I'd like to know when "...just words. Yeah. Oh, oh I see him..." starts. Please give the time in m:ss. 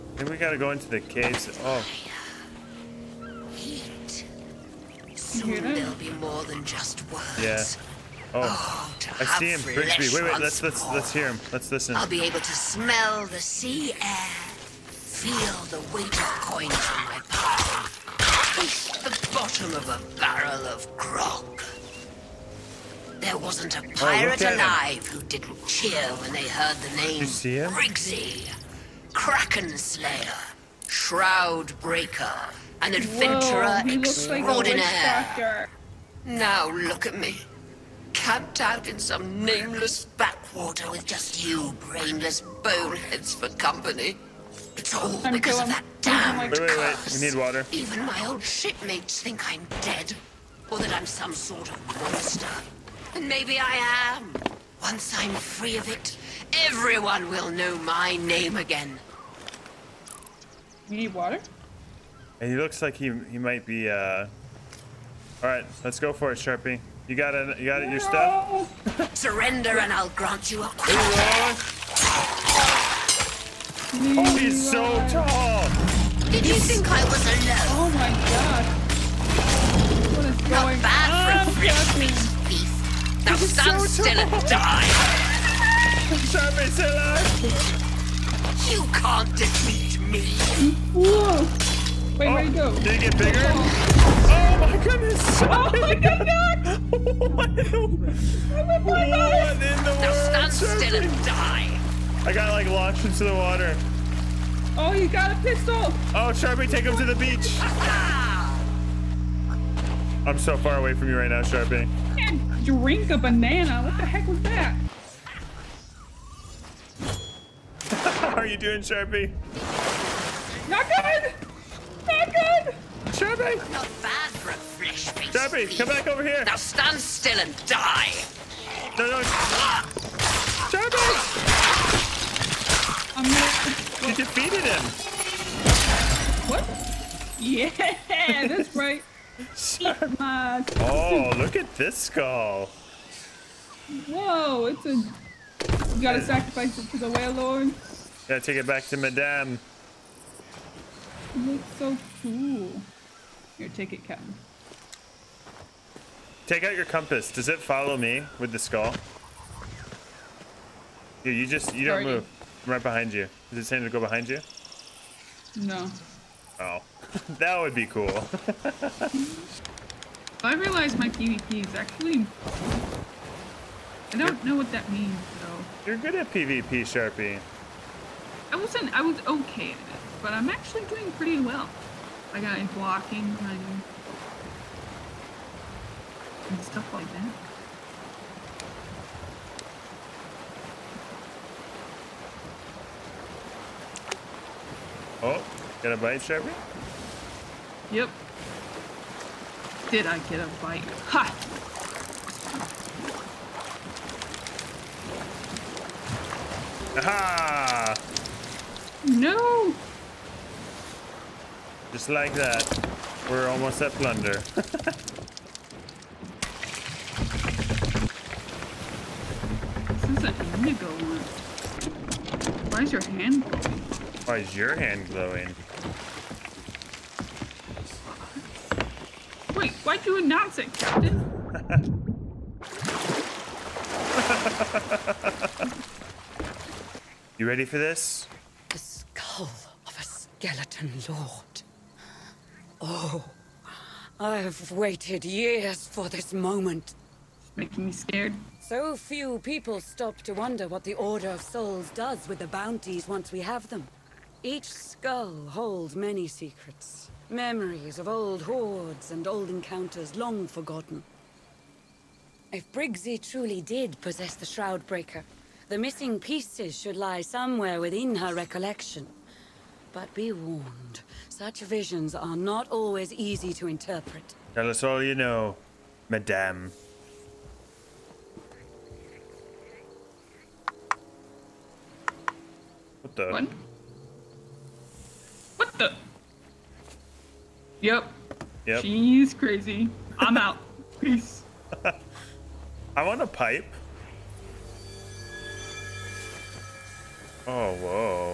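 0:06.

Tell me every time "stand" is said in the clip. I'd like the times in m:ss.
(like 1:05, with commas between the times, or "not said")
1:23, 1:40, 2:06.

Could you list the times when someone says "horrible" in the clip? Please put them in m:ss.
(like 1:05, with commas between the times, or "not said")
not said.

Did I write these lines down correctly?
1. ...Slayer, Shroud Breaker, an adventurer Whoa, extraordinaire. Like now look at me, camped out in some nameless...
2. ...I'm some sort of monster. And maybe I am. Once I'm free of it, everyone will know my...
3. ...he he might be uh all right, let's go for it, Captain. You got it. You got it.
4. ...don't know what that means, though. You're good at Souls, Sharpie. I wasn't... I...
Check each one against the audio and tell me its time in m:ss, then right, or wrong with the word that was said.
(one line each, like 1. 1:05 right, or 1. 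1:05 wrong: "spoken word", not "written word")
1. 0:29 right
2. 0:50 right
3. 1:02 wrong: "Sharpie", not "Captain"
4. 2:54 wrong: "PvP", not "Souls".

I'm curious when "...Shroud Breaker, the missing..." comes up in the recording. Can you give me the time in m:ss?
4:24.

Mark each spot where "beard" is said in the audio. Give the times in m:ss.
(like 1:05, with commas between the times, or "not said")
not said.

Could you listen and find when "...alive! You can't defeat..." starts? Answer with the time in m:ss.
1:26.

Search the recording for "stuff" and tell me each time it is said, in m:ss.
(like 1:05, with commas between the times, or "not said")
1:07, 3:06.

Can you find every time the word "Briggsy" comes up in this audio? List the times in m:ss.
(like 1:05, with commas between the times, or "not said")
0:09, 0:27, 4:22.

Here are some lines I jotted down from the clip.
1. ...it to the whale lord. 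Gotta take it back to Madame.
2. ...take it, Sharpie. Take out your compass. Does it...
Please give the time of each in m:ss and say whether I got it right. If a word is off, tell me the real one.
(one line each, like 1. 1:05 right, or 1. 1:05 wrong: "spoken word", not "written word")
1. 2:26 right
2. 2:33 wrong: "Captain", not "Sharpie".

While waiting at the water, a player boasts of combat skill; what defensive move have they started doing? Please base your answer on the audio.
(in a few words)
blocking.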